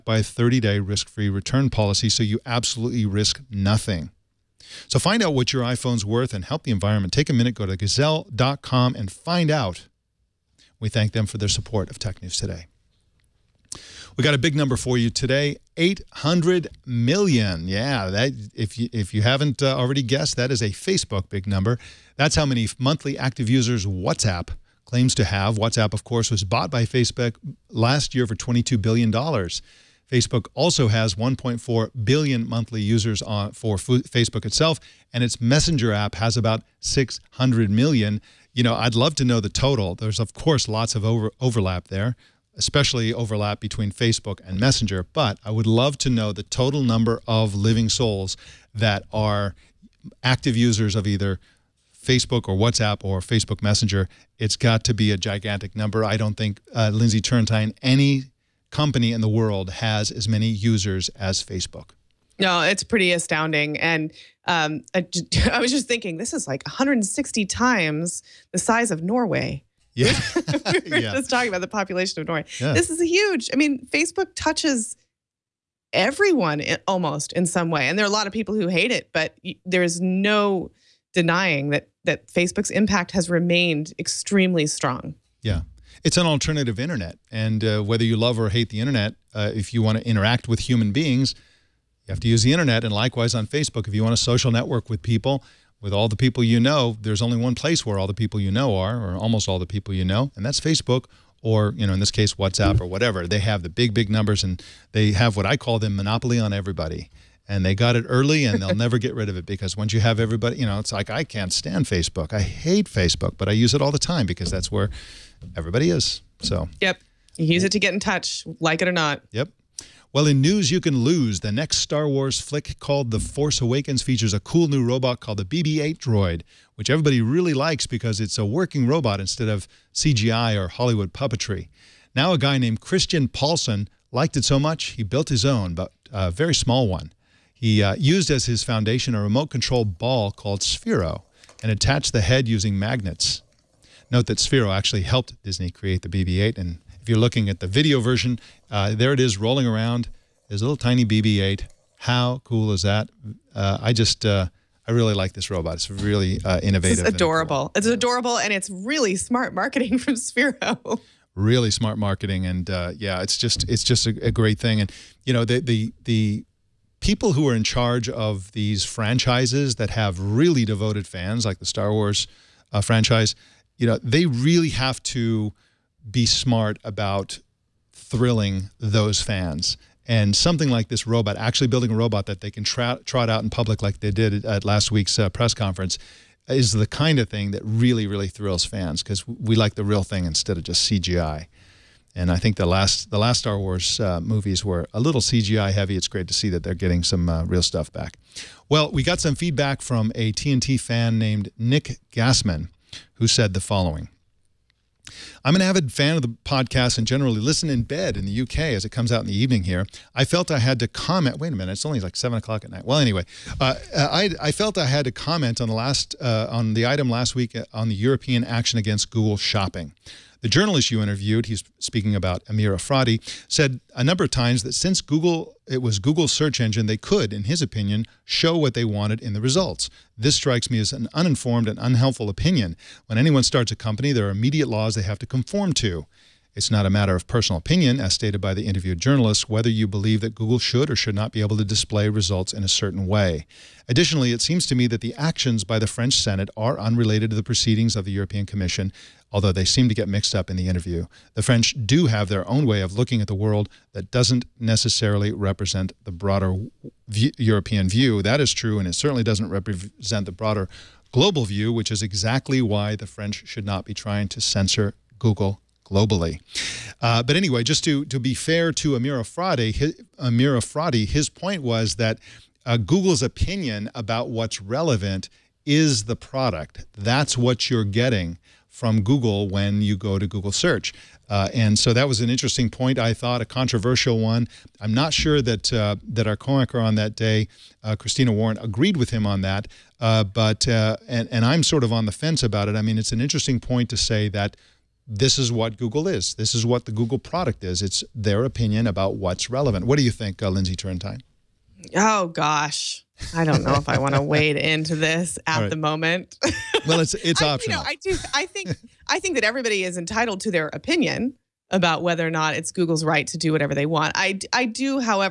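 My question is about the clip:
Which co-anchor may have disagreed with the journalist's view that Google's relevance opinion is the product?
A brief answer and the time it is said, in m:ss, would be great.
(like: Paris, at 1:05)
Christina Warren, at 4:47.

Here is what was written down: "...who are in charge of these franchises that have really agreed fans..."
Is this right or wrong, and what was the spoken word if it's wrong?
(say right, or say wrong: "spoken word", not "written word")
wrong: "devoted", not "agreed".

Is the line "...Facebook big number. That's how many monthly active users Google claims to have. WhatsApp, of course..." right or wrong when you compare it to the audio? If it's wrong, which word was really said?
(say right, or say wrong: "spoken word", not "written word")
wrong: "WhatsApp", not "Google".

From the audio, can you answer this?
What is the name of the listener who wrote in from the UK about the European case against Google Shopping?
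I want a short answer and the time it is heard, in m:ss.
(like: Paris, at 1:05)
Nick Gassman, at 3:21.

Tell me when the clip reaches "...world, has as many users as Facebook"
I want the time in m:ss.
0:59.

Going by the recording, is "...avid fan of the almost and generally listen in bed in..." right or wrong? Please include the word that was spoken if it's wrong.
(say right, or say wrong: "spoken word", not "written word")
wrong: "podcast", not "almost".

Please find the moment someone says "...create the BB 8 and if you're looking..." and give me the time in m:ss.
2:25.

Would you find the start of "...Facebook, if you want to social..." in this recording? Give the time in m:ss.
1:33.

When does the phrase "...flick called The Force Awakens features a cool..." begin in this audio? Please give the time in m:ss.
2:02.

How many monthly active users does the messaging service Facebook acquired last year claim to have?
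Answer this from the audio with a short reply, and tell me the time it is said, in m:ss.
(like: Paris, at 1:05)
800 million, at 0:15.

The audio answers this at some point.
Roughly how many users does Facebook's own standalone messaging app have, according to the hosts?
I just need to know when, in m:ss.
0:36.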